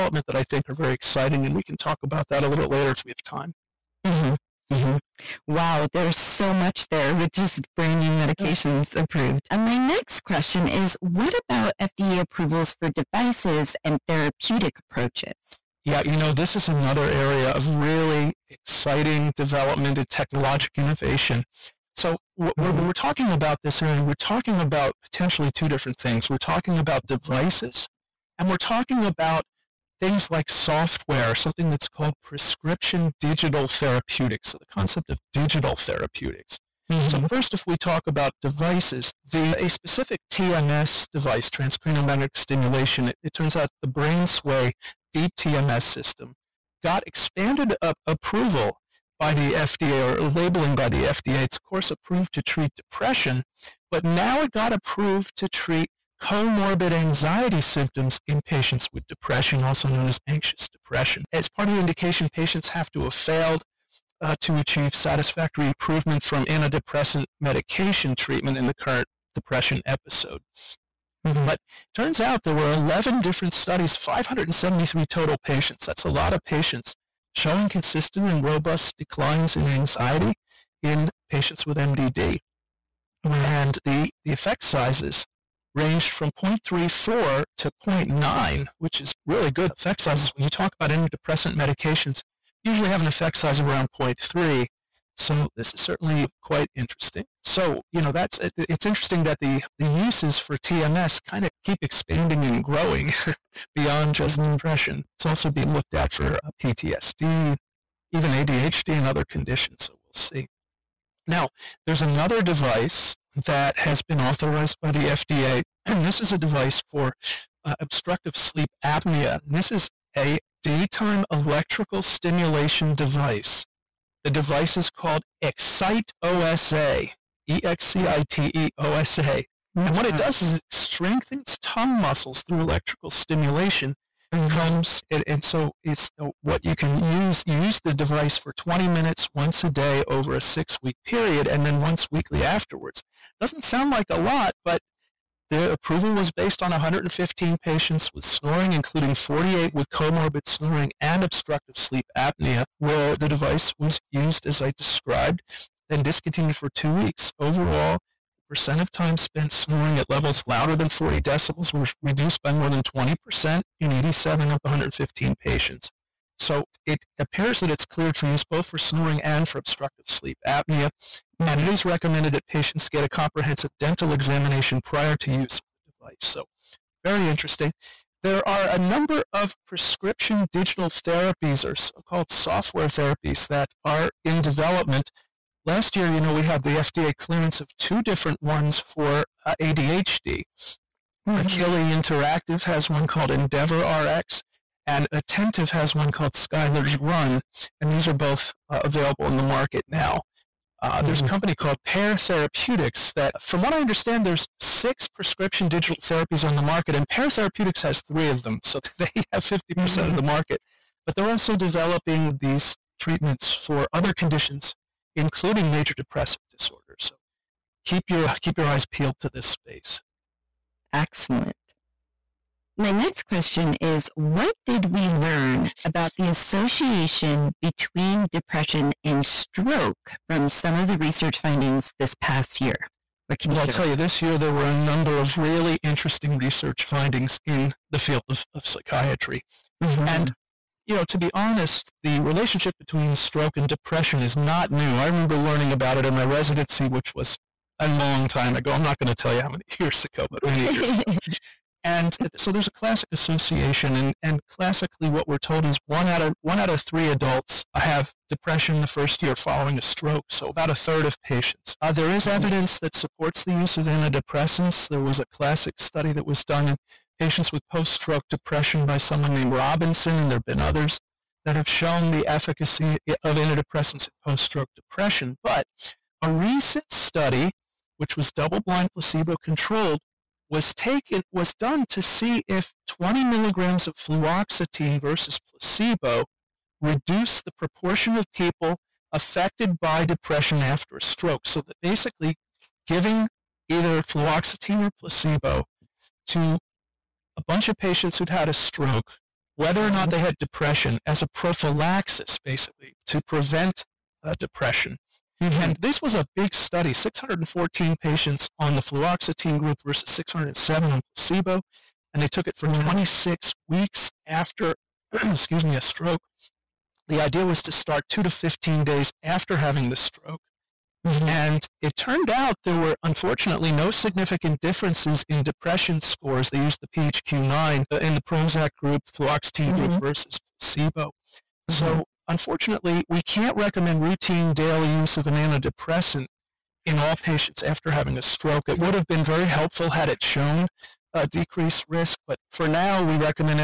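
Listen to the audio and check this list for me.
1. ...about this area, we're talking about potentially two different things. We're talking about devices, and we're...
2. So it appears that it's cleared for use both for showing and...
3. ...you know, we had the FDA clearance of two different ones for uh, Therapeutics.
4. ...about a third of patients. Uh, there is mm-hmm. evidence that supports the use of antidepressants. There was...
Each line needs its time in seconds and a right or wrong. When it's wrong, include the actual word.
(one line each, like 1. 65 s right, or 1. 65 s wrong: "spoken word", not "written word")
1. 23 s right
2. 166 s wrong: "snoring", not "showing"
3. 186 s wrong: "ADHD", not "Therapeutics"
4. 260 s right.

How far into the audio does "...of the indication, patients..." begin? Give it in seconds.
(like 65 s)
61 s.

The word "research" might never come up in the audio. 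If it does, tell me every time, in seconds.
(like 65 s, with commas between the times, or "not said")
230 s, 236 s.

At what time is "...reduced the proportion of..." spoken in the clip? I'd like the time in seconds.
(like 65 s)
286 s.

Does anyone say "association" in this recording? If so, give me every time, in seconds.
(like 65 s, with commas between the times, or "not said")
226 s, 253 s.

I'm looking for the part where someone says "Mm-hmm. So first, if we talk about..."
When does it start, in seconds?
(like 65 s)
36 s.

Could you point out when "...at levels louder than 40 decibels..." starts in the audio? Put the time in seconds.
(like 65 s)
159 s.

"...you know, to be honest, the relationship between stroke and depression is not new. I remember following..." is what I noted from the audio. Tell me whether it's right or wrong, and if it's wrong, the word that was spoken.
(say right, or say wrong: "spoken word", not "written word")
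wrong: "learning", not "following".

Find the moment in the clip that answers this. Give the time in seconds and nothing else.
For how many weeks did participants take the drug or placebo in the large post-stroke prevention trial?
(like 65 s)
312 s.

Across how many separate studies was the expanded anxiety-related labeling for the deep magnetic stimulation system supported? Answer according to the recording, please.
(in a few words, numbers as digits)
11.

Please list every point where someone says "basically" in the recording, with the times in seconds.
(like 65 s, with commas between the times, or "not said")
291 s, 302 s.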